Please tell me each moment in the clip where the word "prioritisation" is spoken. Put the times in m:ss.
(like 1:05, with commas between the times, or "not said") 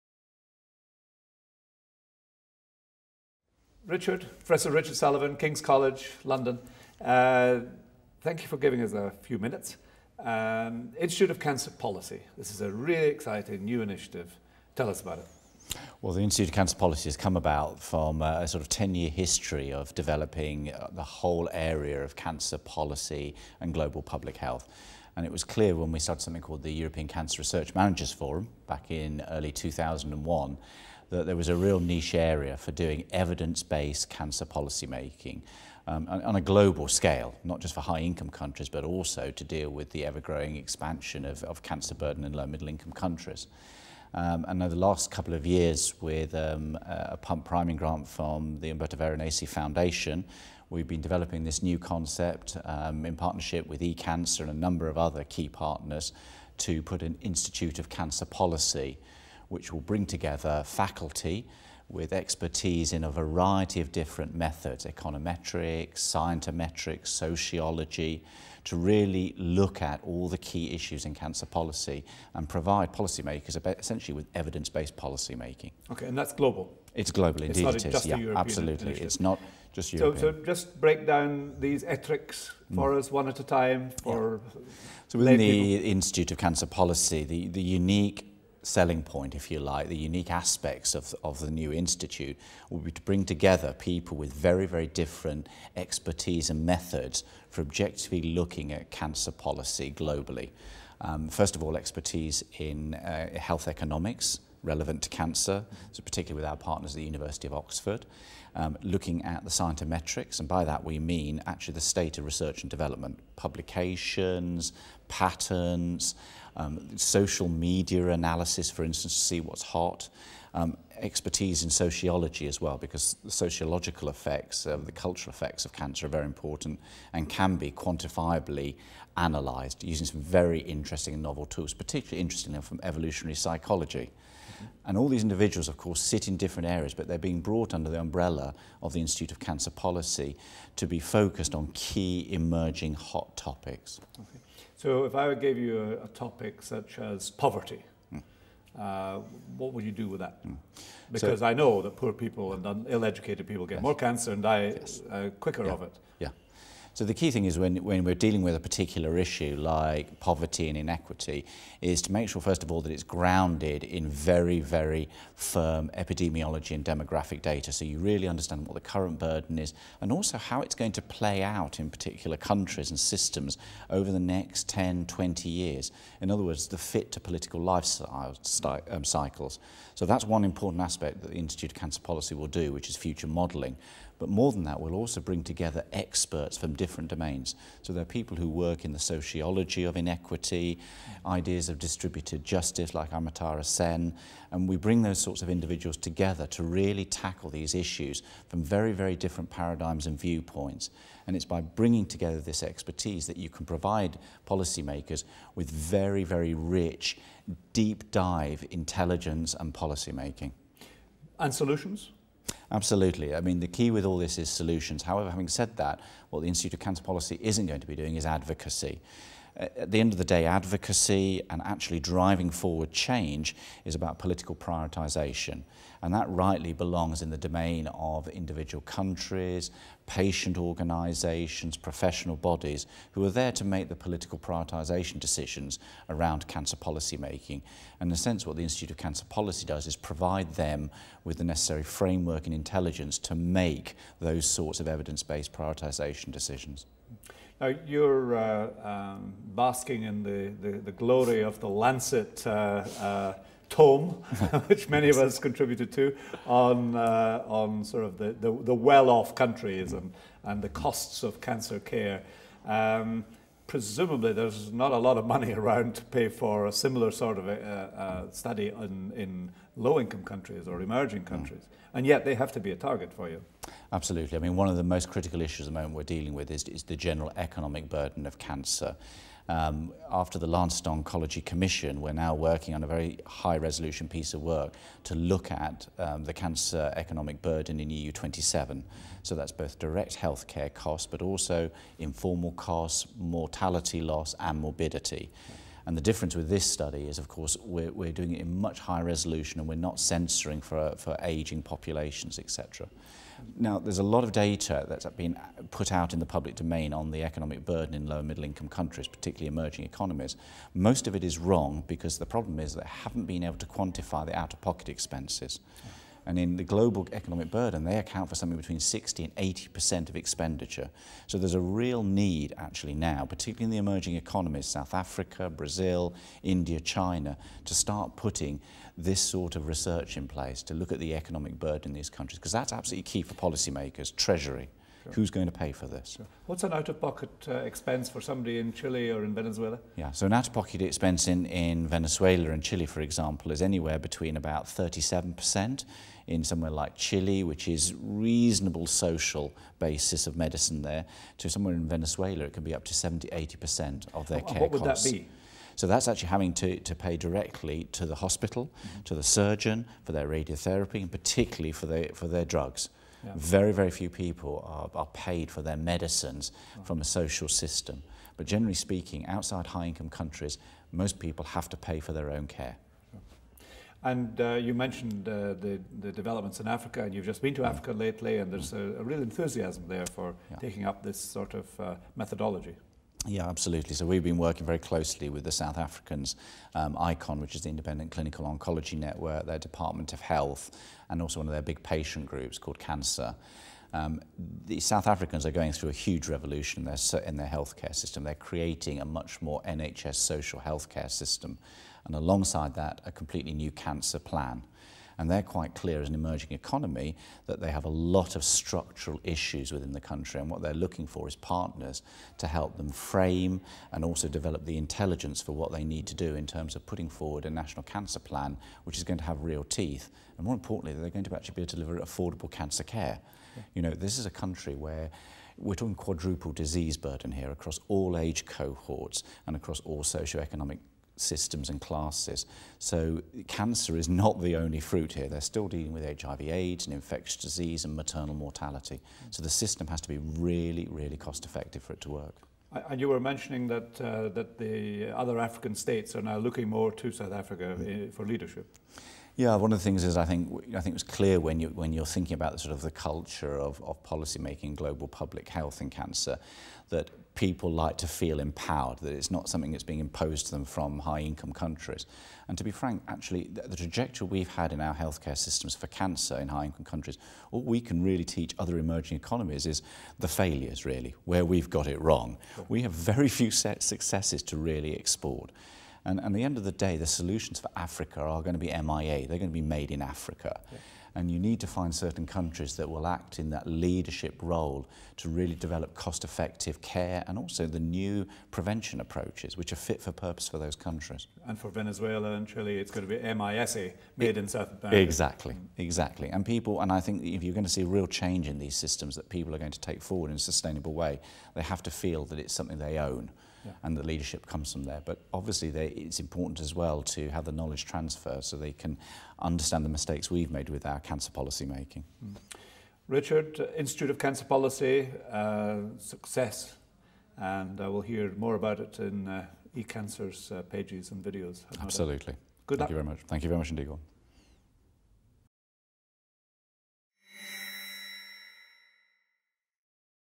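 3:44, 3:54, 4:05.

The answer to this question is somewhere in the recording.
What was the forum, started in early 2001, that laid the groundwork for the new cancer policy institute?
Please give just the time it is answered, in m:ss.
0:26.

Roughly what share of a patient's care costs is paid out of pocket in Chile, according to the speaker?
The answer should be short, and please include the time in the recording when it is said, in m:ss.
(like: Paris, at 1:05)
37%, at 5:44.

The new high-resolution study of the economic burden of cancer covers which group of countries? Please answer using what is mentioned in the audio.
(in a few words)
EU27.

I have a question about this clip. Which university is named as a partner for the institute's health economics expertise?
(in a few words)
University of Oxford.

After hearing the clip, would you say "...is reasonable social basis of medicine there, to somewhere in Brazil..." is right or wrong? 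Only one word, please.
wrong.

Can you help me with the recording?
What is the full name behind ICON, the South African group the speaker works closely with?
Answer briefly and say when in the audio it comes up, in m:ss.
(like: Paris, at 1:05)
Independent Clinical Oncology Network, at 6:27.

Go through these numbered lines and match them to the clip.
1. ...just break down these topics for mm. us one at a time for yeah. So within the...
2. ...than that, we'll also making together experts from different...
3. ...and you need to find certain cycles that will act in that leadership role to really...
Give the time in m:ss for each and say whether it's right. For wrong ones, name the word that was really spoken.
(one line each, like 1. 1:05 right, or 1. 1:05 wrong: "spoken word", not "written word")
1. 1:20 wrong: "ethics", not "topics"
2. 3:04 wrong: "bring", not "making"
3. 8:01 wrong: "countries", not "cycles".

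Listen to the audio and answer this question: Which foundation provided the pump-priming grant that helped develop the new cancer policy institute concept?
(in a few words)
Umberto Veronesi Foundation.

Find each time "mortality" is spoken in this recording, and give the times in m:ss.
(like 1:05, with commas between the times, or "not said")
4:53, 7:18.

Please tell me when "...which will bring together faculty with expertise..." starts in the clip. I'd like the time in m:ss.
0:59.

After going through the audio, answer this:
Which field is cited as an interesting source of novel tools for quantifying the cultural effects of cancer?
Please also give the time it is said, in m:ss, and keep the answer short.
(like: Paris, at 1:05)
Evolutionary psychology, at 2:12.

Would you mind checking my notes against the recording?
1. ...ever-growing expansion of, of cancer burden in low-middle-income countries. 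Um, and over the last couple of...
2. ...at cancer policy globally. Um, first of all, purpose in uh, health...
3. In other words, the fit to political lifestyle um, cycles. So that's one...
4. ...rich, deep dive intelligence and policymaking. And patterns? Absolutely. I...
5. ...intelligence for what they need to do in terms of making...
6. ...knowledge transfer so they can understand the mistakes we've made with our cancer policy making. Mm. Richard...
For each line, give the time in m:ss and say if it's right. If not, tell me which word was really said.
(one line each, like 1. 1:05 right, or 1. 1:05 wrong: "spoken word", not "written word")
1. 0:40 right
2. 1:38 wrong: "expertise", not "purpose"
3. 2:56 right
4. 3:26 wrong: "solutions", not "patterns"
5. 6:54 wrong: "putting", not "making"
6. 8:27 right.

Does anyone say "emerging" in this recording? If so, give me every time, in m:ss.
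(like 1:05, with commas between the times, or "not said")
2:22, 4:30, 5:09, 5:23, 6:46, 7:48.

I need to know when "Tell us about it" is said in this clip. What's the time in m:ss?
0:14.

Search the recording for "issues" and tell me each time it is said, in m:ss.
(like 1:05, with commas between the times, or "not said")
1:10, 2:39, 3:17, 4:35, 6:49.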